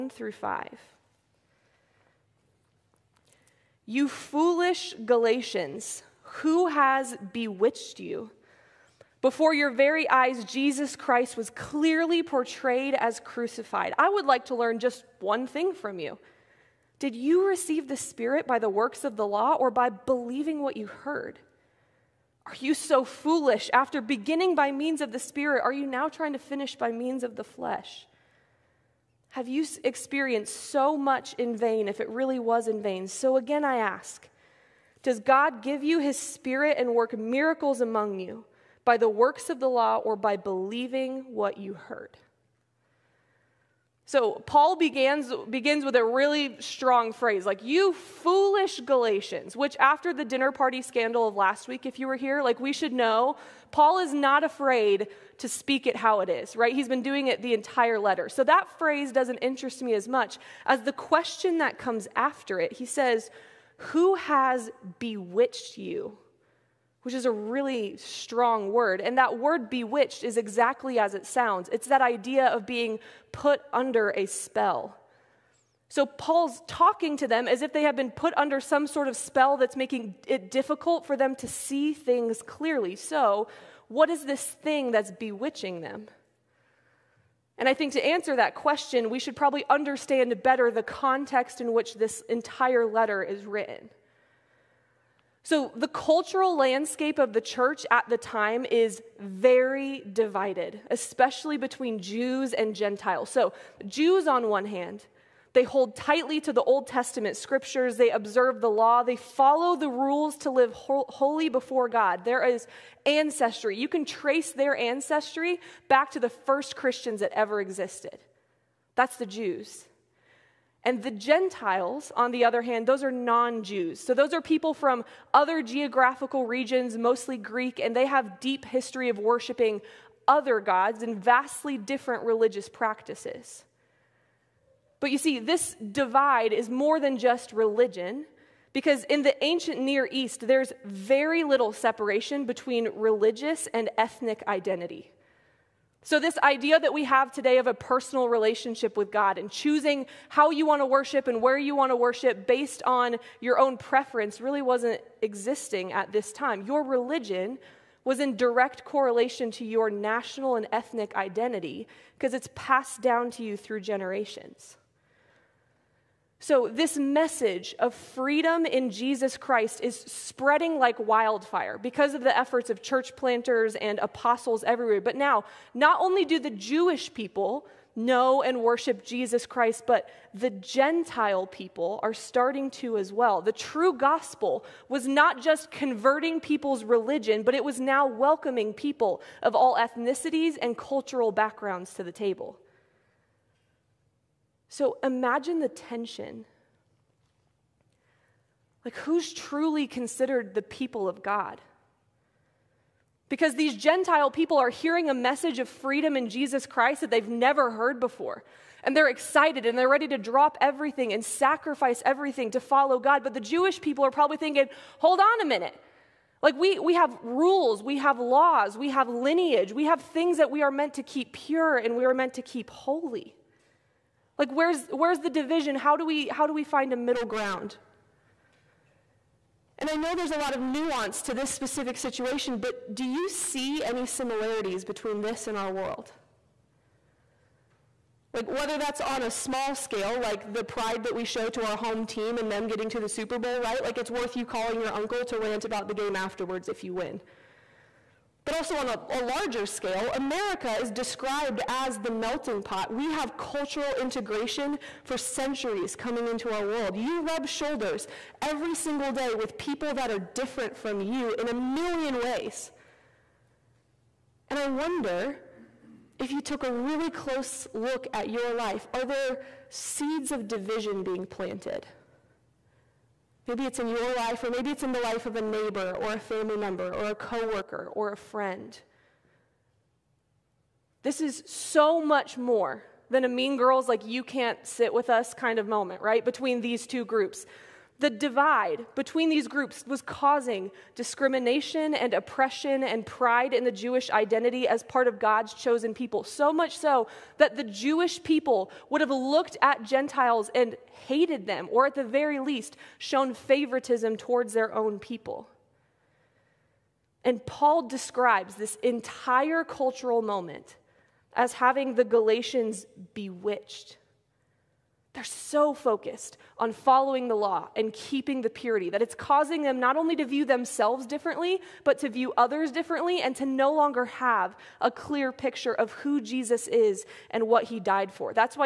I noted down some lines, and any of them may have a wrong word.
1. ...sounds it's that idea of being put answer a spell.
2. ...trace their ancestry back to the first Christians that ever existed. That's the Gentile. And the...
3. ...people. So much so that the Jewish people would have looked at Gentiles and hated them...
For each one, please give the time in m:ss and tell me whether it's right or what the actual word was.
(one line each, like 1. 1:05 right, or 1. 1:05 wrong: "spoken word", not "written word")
1. 1:11 wrong: "under", not "answer"
2. 1:54 wrong: "Jews", not "Gentile"
3. 4:55 right.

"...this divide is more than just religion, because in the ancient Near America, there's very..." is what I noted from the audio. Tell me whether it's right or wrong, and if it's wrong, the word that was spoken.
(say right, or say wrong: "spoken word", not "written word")
wrong: "East", not "America".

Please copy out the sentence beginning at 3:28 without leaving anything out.
And they're excited and they're ready to drop everything and sacrifice everything to follow God.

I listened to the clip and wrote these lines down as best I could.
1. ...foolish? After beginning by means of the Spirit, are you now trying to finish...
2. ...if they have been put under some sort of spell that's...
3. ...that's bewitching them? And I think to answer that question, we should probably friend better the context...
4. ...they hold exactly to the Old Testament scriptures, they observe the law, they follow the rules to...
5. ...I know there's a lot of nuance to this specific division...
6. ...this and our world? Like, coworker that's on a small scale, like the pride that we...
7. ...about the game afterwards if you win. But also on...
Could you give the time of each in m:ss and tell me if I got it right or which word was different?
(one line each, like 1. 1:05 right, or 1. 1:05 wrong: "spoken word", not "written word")
1. 0:23 right
2. 1:17 right
3. 1:24 wrong: "understand", not "friend"
4. 1:45 wrong: "tightly", not "exactly"
5. 3:49 wrong: "situation", not "division"
6. 3:55 wrong: "whether", not "coworker"
7. 4:05 right.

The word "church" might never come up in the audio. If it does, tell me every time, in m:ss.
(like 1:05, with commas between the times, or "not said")
1:37, 2:52.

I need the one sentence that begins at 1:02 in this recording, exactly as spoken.
He says, Who has bewitched you?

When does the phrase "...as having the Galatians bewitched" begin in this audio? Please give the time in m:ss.
5:11.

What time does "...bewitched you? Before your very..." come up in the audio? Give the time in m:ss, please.
0:07.